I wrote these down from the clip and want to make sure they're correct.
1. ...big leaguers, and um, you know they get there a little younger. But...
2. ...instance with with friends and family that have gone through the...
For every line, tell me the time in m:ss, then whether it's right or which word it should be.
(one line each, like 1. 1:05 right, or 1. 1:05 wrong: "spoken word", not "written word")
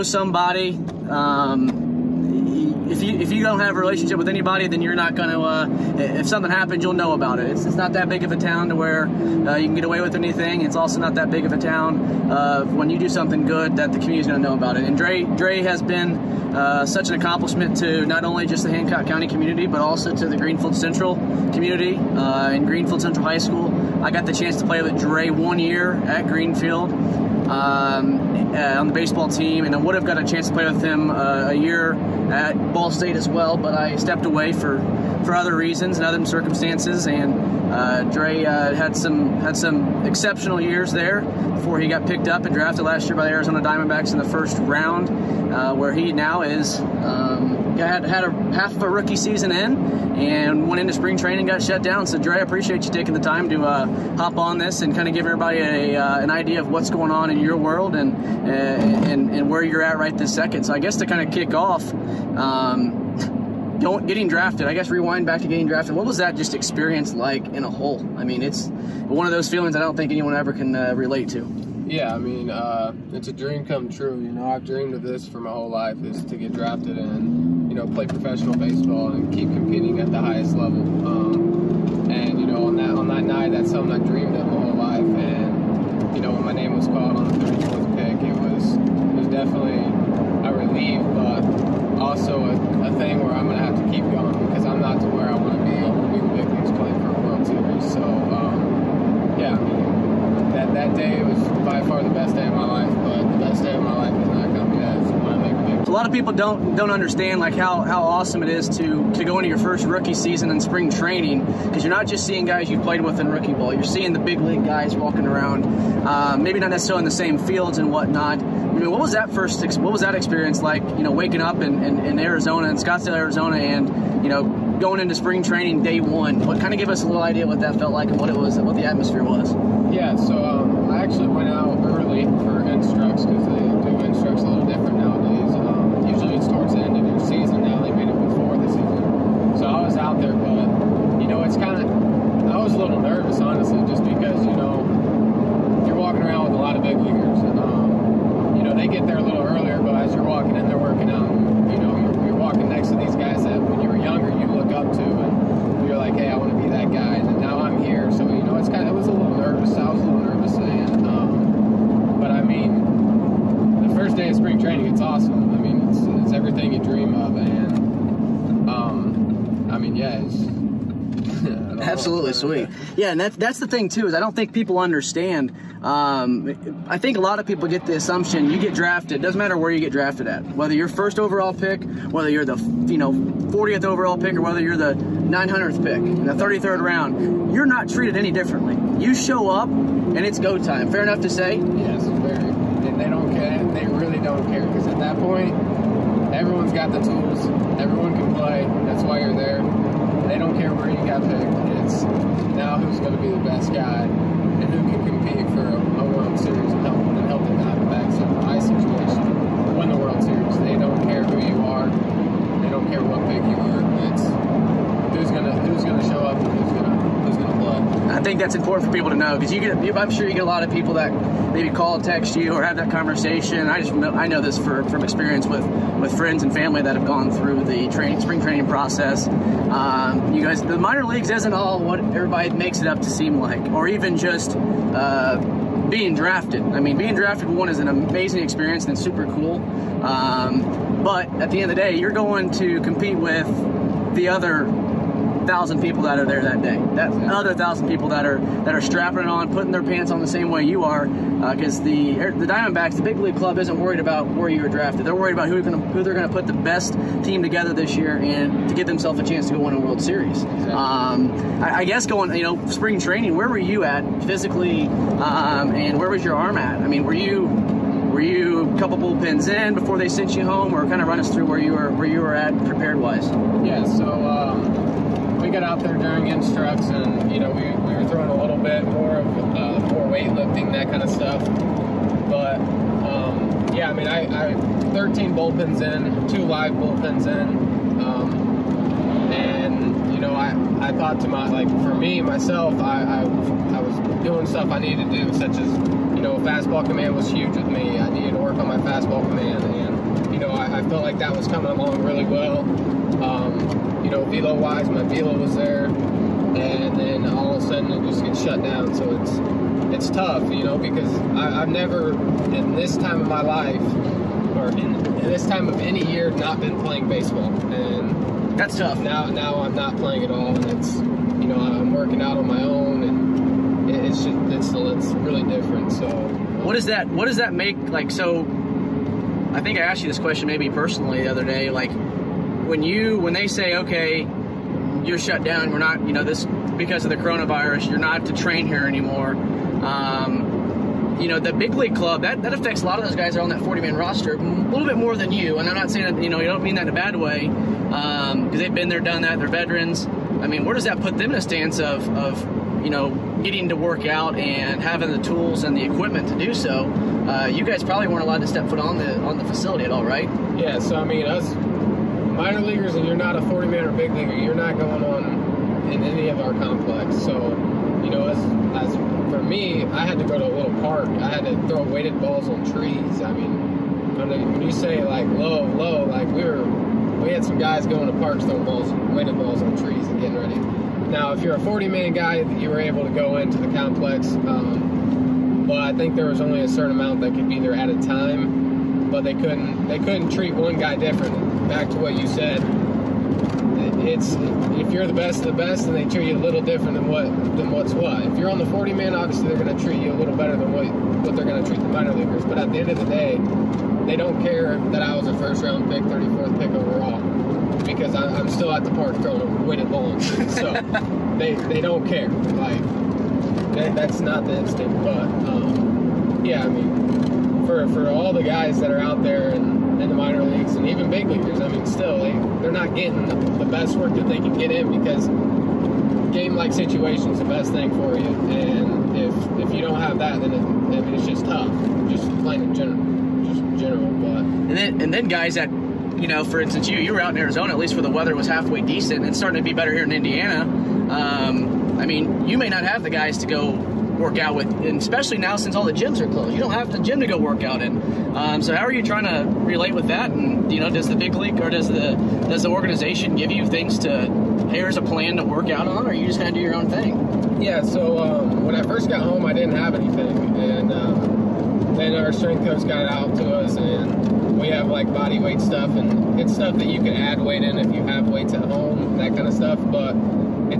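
1. 2:26 wrong: "earlier", not "younger"
2. 3:45 wrong: "experience", not "instance".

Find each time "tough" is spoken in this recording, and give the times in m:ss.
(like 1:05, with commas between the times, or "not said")
5:10, 5:18, 7:11.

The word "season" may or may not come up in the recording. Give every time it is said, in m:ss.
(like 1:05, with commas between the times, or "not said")
0:49, 1:50.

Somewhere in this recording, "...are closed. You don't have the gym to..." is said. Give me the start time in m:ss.
7:26.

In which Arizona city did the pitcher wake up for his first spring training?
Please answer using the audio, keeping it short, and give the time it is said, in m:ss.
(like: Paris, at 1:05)
Scottsdale, at 2:02.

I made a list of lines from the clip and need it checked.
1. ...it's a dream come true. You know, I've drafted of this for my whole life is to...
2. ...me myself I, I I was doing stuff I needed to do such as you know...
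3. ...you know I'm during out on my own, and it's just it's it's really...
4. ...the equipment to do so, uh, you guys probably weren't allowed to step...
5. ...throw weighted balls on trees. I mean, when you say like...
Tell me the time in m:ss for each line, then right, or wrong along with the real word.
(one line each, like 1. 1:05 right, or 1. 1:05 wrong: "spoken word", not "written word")
1. 1:13 wrong: "dreamed", not "drafted"
2. 4:51 right
3. 5:20 wrong: "working", not "during"
4. 5:55 right
5. 6:11 right.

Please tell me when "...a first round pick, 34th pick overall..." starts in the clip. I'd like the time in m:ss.
6:45.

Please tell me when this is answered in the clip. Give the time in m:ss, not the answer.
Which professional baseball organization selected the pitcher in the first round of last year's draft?
0:43.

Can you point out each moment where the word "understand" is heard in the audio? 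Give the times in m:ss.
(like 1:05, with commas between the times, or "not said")
1:46, 2:54.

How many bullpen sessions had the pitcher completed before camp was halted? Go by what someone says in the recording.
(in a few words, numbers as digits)
13.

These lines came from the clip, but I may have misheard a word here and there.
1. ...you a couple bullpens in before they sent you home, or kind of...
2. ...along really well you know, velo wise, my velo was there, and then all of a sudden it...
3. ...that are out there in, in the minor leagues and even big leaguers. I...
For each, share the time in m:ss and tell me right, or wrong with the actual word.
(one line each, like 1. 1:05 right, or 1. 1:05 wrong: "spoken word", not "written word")
1. 4:28 right
2. 5:01 right
3. 6:58 right.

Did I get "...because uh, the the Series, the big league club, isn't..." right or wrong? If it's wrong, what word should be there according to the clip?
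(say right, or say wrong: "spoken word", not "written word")
wrong: "Diamondbacks", not "Series".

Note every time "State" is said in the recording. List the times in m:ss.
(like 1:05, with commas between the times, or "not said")
0:32.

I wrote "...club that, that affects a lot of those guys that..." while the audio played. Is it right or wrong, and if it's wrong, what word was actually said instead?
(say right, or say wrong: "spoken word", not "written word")
right.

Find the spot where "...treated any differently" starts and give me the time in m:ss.
3:07.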